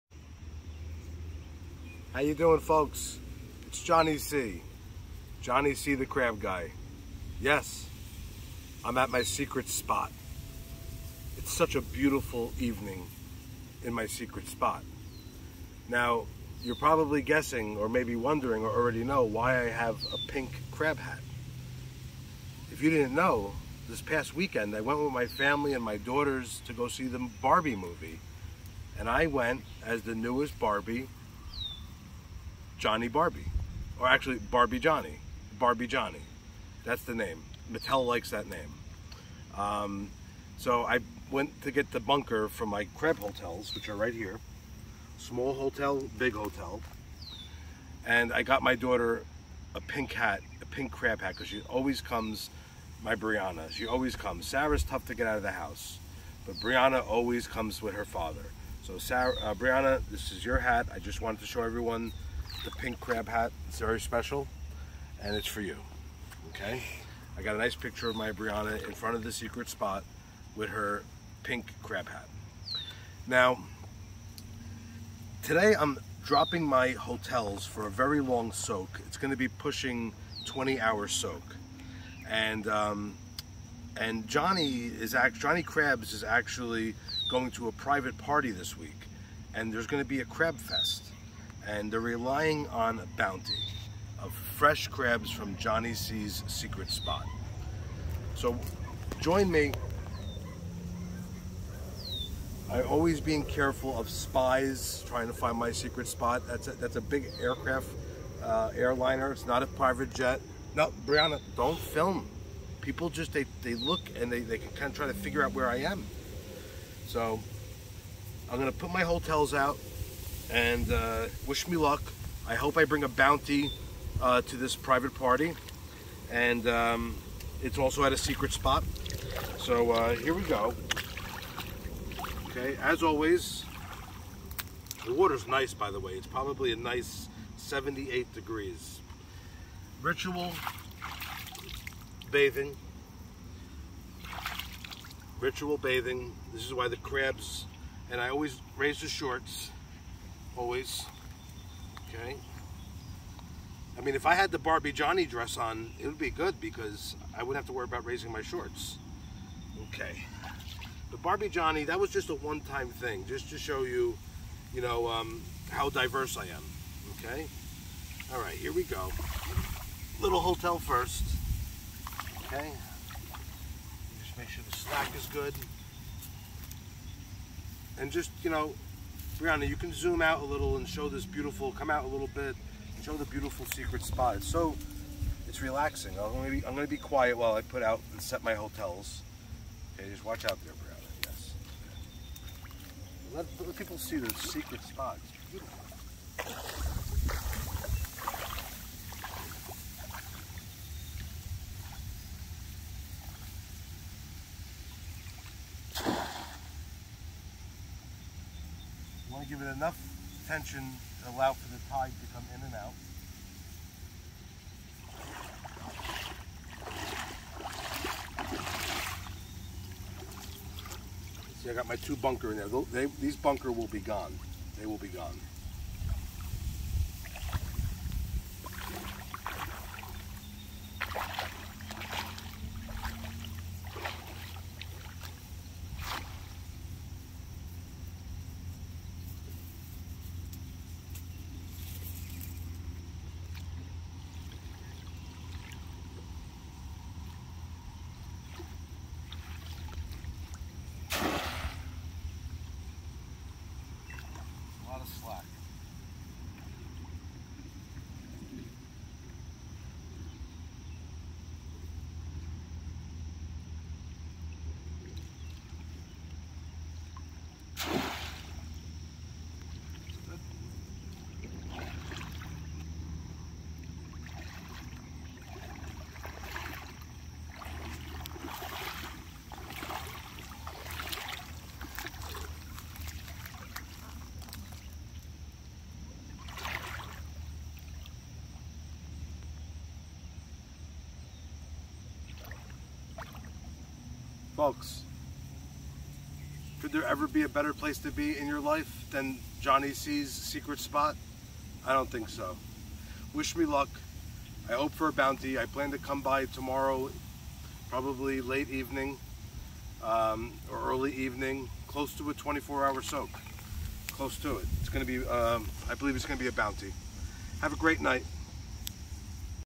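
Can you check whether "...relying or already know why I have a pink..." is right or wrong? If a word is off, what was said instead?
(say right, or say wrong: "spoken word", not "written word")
wrong: "wondering", not "relying".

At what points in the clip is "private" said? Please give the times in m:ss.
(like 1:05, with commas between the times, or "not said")
1:27, 1:49, 2:04.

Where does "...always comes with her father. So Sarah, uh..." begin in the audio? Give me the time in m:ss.
0:57.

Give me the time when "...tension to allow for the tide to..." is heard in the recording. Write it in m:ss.
3:30.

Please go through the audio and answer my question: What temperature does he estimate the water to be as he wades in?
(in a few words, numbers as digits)
78 degrees.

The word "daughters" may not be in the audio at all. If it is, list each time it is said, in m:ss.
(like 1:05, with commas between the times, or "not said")
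0:25, 0:48.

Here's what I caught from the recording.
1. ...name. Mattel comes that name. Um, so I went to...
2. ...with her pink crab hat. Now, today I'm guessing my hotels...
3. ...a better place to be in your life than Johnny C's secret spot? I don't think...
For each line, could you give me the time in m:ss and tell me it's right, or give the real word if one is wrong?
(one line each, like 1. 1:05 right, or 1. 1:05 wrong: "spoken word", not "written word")
1. 0:37 wrong: "likes", not "comes"
2. 1:10 wrong: "dropping", not "guessing"
3. 4:57 right.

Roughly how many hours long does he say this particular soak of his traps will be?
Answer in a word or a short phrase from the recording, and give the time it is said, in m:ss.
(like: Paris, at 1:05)
20 hours, at 1:20.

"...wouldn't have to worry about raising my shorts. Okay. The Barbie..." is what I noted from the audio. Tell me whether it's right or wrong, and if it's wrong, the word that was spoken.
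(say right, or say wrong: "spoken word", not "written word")
right.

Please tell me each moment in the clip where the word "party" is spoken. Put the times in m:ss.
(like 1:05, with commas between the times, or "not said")
1:28, 2:05.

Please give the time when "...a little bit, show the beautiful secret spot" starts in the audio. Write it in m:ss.
3:02.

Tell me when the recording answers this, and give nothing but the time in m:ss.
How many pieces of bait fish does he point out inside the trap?
3:41.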